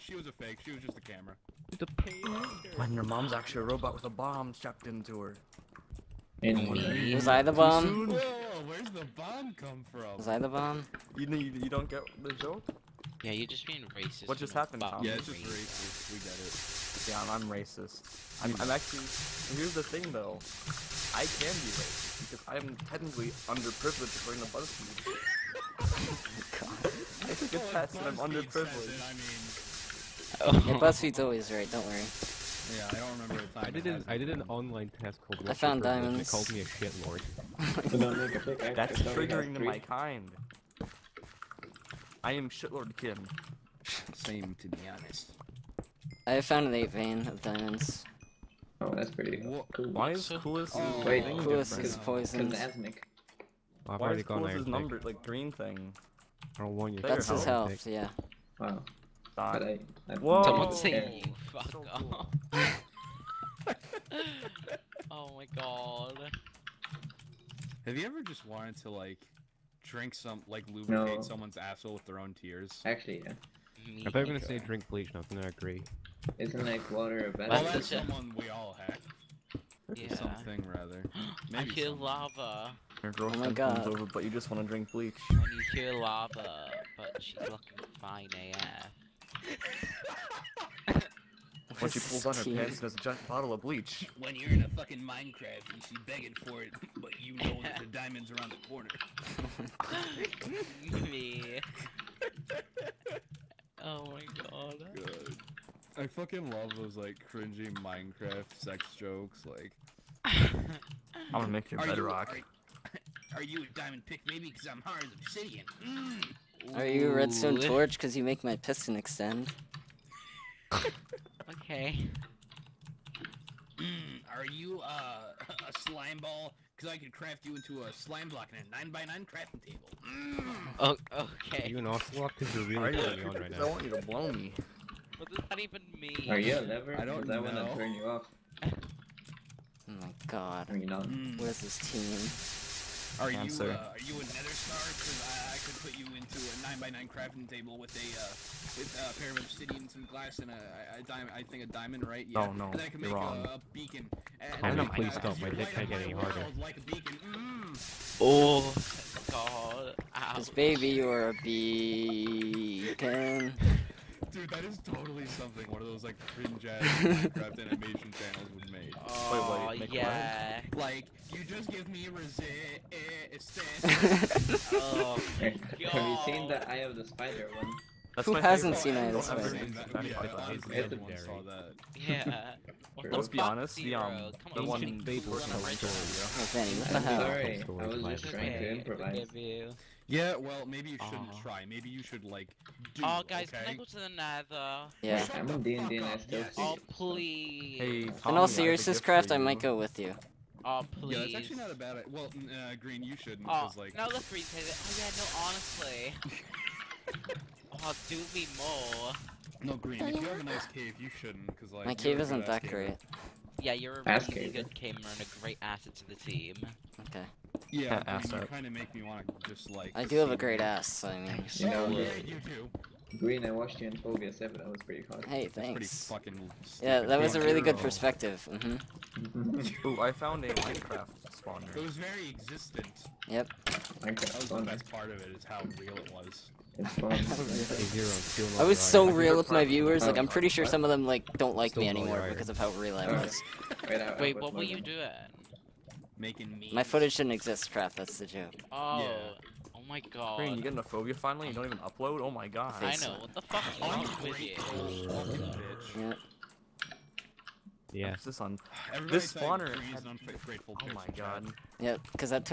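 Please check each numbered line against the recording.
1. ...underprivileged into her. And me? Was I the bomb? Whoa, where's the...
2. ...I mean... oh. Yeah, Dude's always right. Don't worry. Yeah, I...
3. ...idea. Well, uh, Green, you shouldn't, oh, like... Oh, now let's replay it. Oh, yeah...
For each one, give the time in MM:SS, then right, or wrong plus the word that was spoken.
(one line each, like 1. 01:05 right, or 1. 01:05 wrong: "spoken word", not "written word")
1. 00:04 wrong: "strapped", not "underprivileged"
2. 00:30 wrong: "BuzzFeed", not "Dude"
3. 03:21 right.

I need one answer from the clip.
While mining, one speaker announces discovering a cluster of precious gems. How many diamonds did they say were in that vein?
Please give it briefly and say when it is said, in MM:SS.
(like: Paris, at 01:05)
8, at 00:46.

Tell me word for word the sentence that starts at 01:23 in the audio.
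comes over, but you just want to drink bleach.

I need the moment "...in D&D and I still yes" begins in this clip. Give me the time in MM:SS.
03:15.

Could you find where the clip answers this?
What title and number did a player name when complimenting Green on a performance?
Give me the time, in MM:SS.
03:43.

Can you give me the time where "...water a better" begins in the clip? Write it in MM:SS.
01:16.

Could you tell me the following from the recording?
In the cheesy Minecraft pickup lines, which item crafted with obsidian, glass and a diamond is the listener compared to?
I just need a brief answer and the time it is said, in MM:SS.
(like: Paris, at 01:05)
Nether star, at 02:23.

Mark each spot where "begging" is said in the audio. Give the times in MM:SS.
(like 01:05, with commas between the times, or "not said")
01:36.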